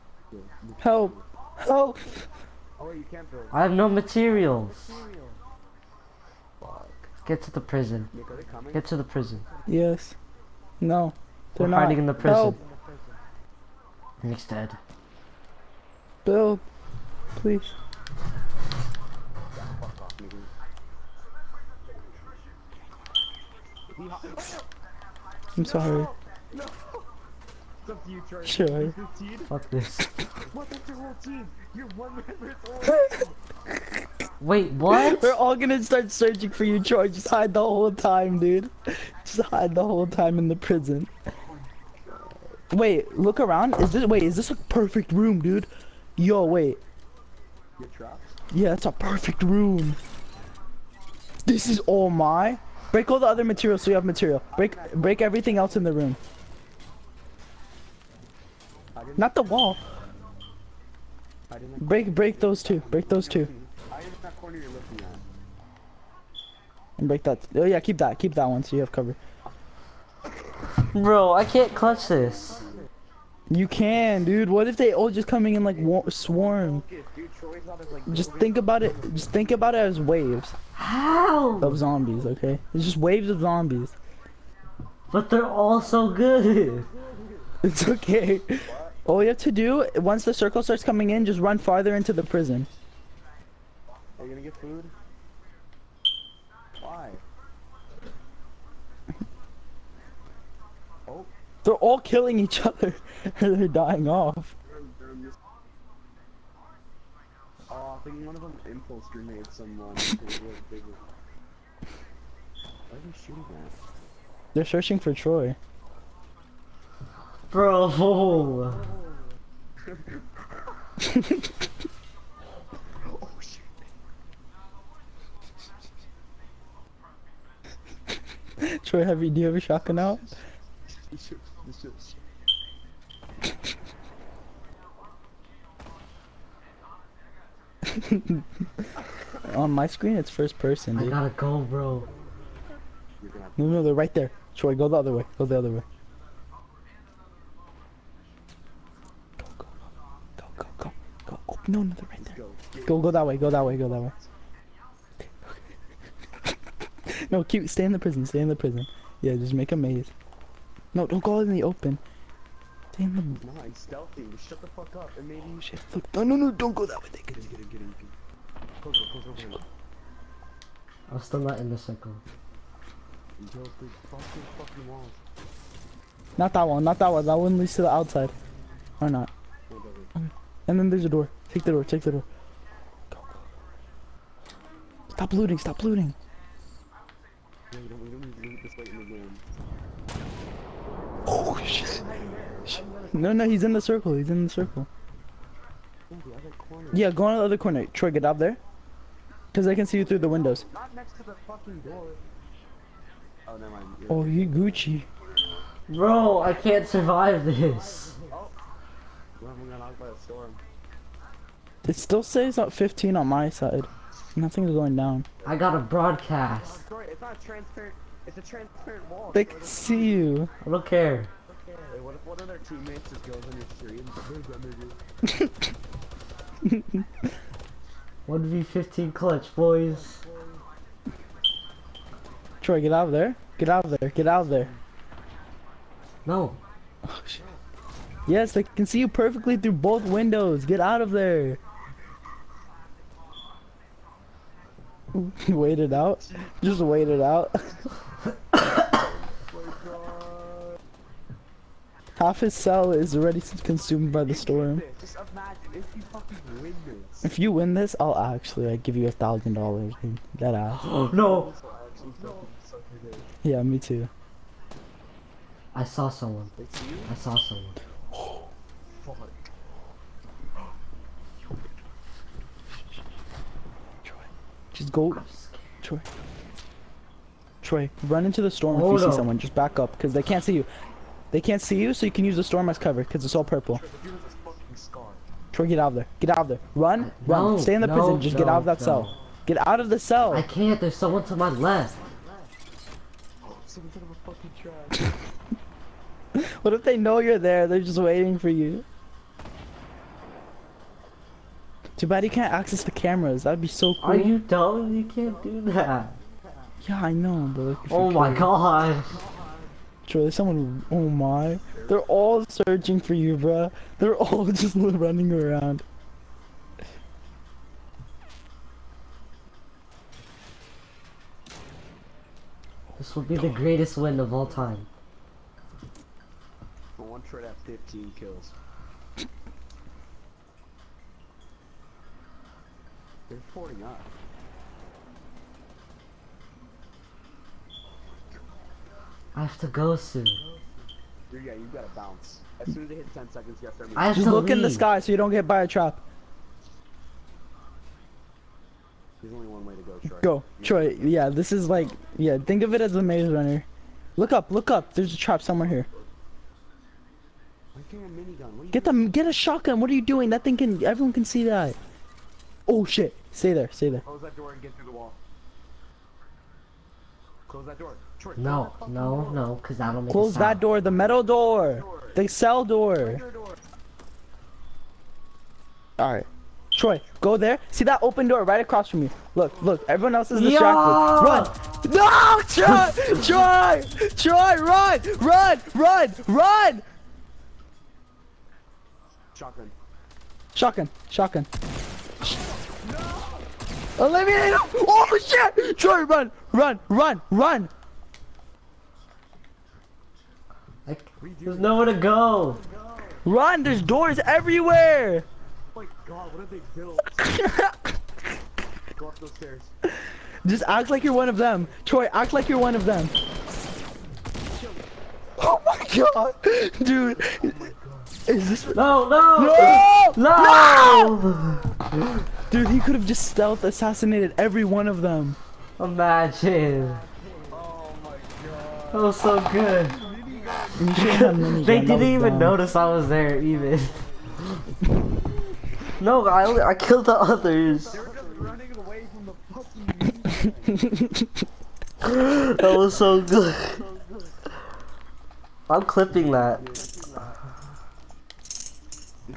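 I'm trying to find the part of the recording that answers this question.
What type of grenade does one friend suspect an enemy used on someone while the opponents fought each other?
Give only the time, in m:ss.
1:48.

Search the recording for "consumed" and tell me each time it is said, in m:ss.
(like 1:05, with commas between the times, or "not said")
4:13.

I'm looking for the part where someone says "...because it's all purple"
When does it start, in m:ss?
4:43.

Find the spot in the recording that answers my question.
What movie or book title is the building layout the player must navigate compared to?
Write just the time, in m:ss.
5:53.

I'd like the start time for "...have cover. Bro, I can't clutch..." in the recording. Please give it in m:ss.
1:08.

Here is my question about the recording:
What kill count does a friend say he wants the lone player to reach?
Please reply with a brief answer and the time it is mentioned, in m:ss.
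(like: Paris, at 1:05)
15, at 5:27.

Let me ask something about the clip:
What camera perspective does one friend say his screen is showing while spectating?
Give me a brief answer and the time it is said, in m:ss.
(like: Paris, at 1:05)
First person, at 2:20.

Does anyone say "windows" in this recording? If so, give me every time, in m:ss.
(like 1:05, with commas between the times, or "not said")
3:20, 4:00.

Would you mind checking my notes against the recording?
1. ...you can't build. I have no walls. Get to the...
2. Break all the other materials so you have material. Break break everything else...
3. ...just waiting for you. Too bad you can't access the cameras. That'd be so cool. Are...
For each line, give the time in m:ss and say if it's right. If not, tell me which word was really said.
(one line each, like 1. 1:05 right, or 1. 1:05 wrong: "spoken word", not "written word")
1. 0:02 wrong: "materials", not "walls"
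2. 0:52 right
3. 4:57 right.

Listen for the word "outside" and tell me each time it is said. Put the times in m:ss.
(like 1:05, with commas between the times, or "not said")
2:57.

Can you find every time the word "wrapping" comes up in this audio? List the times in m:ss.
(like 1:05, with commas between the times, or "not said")
not said.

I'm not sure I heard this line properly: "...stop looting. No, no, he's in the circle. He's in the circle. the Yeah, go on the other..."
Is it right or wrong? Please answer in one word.
right.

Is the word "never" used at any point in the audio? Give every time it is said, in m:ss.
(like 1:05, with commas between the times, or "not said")
3:23.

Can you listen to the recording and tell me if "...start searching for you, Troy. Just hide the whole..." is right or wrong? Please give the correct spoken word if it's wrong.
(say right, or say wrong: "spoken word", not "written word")
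right.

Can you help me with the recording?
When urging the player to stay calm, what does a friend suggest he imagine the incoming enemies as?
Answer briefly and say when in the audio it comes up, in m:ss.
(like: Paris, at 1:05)
Waves of zombies, at 1:22.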